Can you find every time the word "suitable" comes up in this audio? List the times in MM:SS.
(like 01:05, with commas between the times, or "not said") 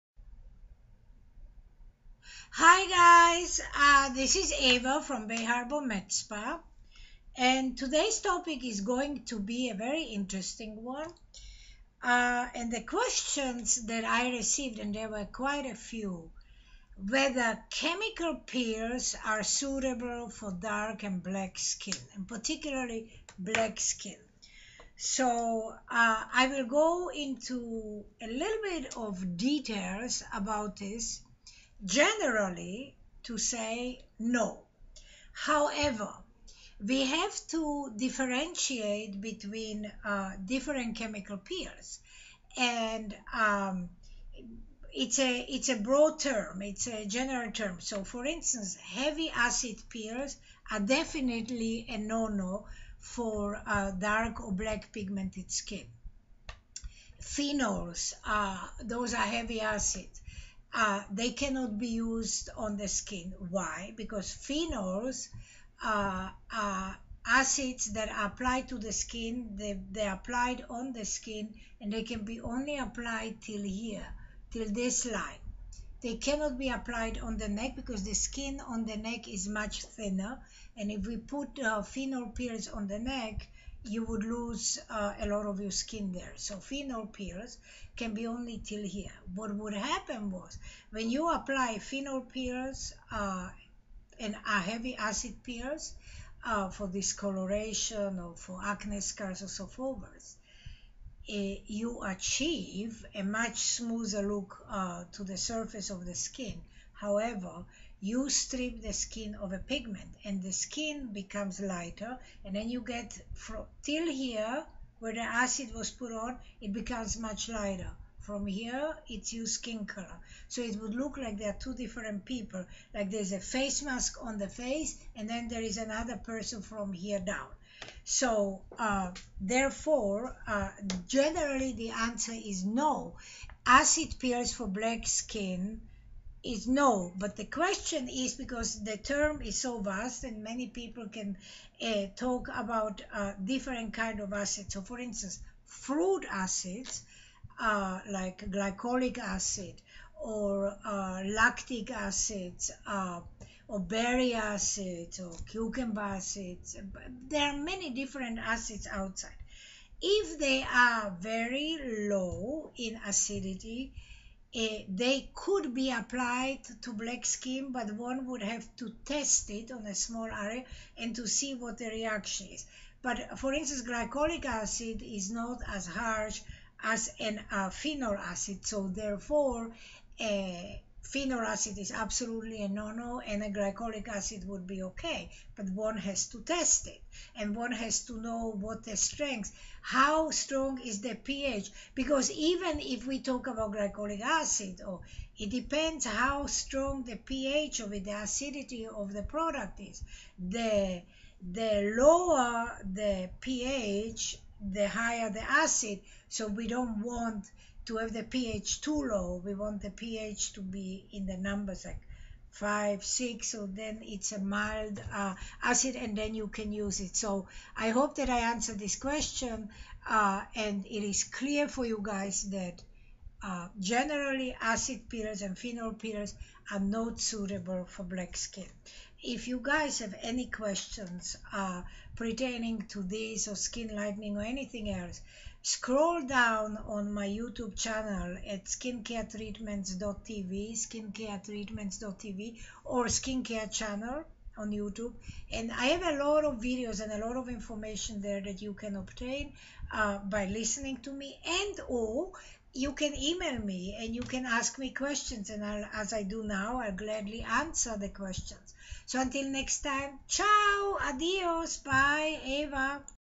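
00:19, 03:47.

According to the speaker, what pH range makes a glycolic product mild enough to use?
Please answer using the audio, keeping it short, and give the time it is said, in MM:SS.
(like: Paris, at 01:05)
5 to 6, at 03:32.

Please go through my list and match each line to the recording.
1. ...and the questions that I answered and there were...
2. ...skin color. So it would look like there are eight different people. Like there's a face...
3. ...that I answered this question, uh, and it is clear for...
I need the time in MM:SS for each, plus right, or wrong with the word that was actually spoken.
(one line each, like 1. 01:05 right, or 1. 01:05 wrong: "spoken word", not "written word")
1. 00:12 wrong: "received", not "answered"
2. 01:59 wrong: "two", not "eight"
3. 03:38 right.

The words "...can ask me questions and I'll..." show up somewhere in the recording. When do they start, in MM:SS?
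04:14.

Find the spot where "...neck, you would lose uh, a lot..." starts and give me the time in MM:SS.
01:22.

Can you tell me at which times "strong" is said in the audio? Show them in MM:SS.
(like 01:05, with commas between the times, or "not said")
03:10, 03:16.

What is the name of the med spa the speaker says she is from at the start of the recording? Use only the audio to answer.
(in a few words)
Bay Harbour Med Spa.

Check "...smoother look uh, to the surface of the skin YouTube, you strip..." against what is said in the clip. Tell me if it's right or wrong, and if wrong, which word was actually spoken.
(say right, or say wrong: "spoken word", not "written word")
wrong: "However", not "YouTube".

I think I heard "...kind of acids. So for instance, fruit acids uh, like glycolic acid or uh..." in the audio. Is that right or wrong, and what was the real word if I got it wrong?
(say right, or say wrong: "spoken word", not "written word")
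right.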